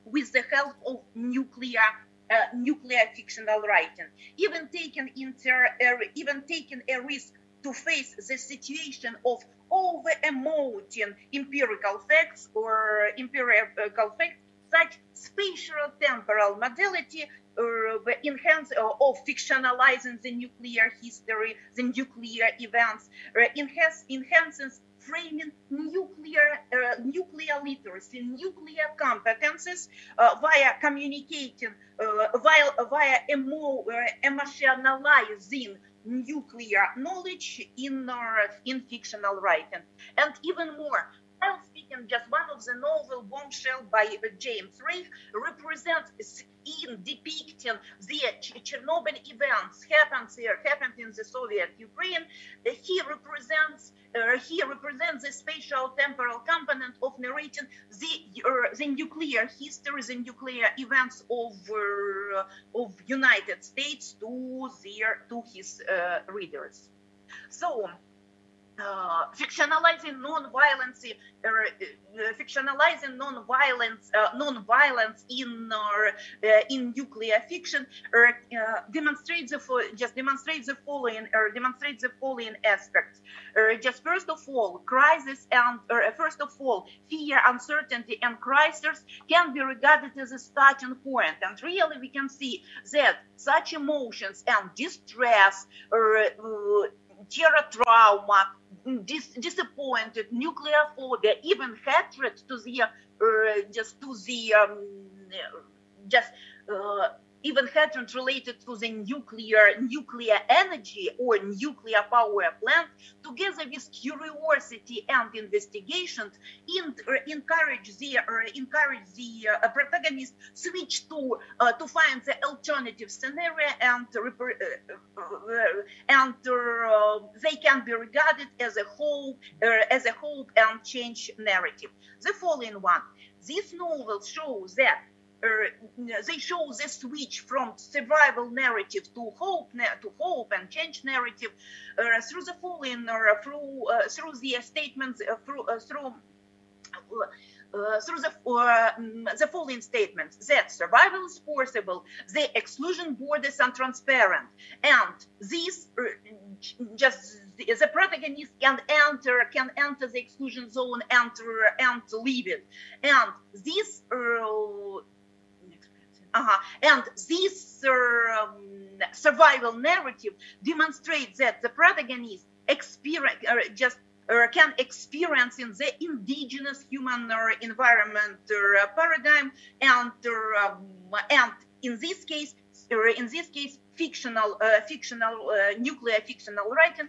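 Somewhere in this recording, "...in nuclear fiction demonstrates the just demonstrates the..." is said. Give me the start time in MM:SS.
01:16.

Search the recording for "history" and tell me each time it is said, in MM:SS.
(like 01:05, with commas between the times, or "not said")
00:21, 00:59.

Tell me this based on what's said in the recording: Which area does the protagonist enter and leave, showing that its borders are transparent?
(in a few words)
The exclusion zone.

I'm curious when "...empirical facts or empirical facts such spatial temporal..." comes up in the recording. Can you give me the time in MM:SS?
00:11.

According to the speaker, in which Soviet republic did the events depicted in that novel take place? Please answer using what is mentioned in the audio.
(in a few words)
Soviet Ukraine.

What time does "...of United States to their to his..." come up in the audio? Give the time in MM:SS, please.
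01:02.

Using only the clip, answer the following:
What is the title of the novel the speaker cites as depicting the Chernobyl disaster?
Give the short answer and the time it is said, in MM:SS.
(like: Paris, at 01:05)
Bombshell, at 00:43.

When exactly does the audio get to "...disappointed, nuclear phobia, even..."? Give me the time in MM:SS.
01:39.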